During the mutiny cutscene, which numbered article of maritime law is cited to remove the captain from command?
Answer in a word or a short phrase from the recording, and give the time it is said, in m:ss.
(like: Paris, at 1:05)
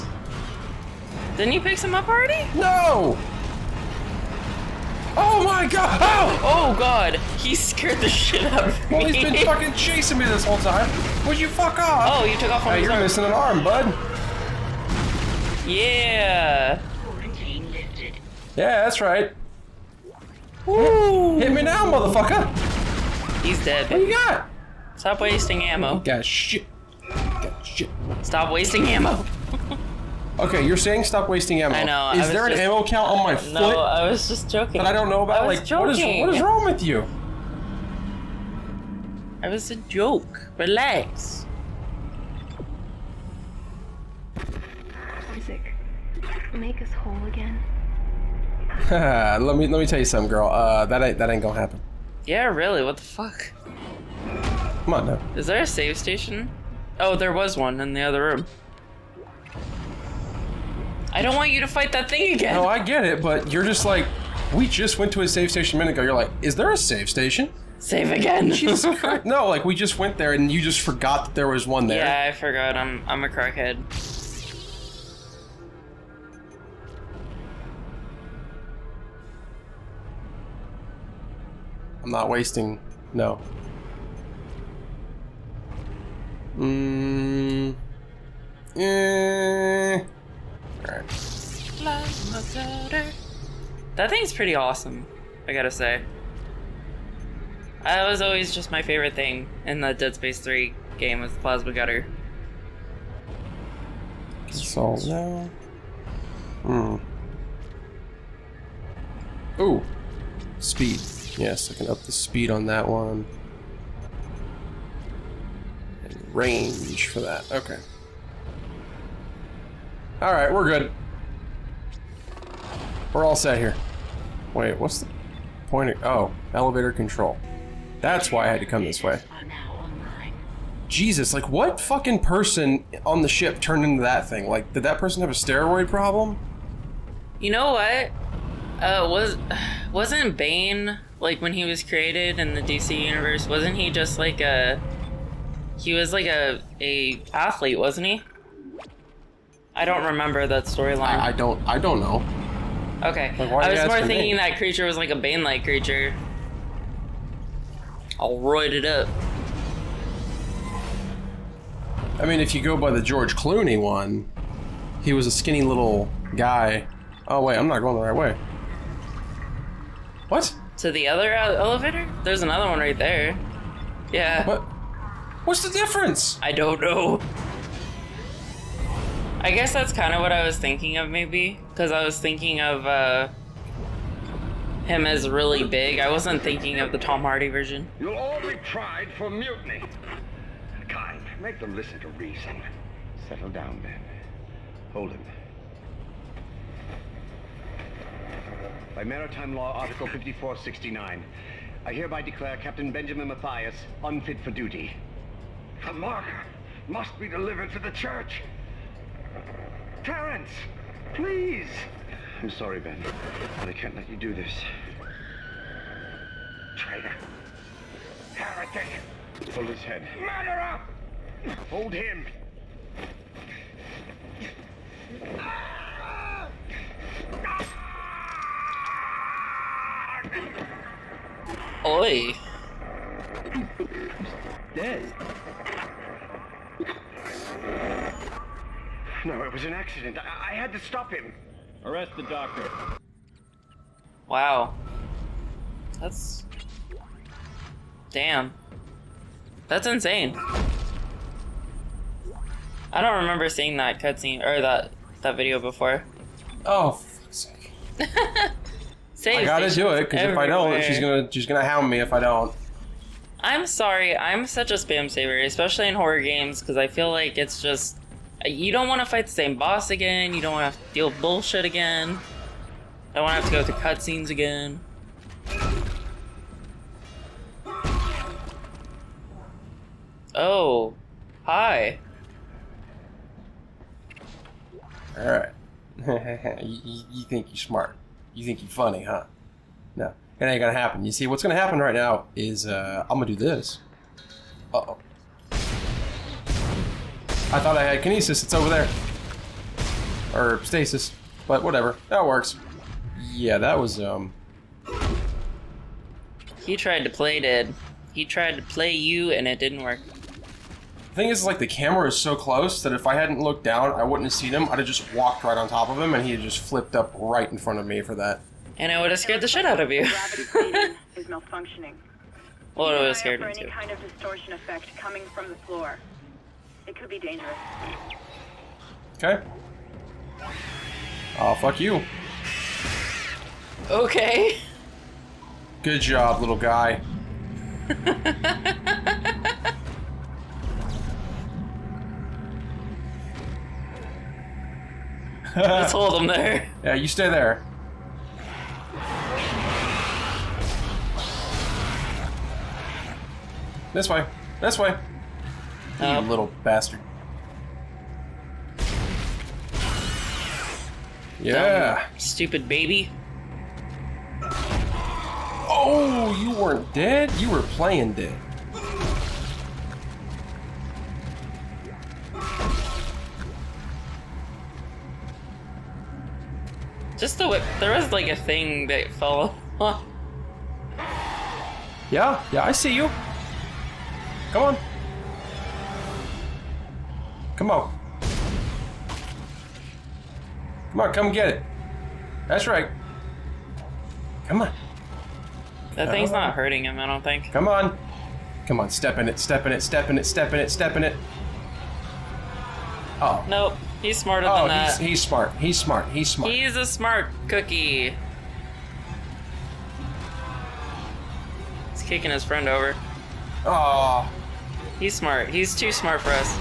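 Article 5469, at 3:19.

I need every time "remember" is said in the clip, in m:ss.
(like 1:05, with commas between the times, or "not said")
2:30, 4:13.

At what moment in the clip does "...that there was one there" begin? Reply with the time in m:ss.
1:11.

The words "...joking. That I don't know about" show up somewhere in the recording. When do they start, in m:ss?
0:34.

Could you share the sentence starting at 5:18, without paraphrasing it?
And I would have scared the shit out of you.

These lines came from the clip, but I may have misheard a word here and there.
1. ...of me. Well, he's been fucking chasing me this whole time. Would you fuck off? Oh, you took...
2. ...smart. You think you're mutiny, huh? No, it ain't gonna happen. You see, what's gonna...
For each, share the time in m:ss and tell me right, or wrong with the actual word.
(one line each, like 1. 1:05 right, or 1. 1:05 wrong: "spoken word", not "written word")
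1. 0:08 right
2. 4:47 wrong: "funny", not "mutiny".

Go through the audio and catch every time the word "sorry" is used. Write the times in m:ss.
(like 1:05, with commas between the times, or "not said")
3:32, 4:23.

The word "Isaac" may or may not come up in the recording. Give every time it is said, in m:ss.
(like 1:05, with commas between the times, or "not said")
0:45.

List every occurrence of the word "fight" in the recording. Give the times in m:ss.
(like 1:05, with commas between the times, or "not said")
1:01, 4:29.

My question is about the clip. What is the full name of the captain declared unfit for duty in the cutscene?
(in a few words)
Benjamin Matthias.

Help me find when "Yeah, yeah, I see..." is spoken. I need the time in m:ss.
6:22.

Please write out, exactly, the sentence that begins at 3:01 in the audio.
Because I was thinking of uh, him as really big.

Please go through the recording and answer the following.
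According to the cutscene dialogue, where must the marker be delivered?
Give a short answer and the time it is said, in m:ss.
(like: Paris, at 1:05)
the church, at 3:27.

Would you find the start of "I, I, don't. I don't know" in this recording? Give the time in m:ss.
2:31.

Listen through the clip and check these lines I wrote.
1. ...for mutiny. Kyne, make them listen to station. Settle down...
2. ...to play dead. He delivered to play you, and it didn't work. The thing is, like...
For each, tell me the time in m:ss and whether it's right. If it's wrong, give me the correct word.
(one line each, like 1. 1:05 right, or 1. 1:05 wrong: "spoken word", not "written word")
1. 3:09 wrong: "reason", not "station"
2. 5:07 wrong: "tried", not "delivered".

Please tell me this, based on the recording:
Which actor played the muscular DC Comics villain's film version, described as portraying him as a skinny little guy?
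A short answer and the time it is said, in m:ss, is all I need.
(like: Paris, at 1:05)
George Clooney, at 2:43.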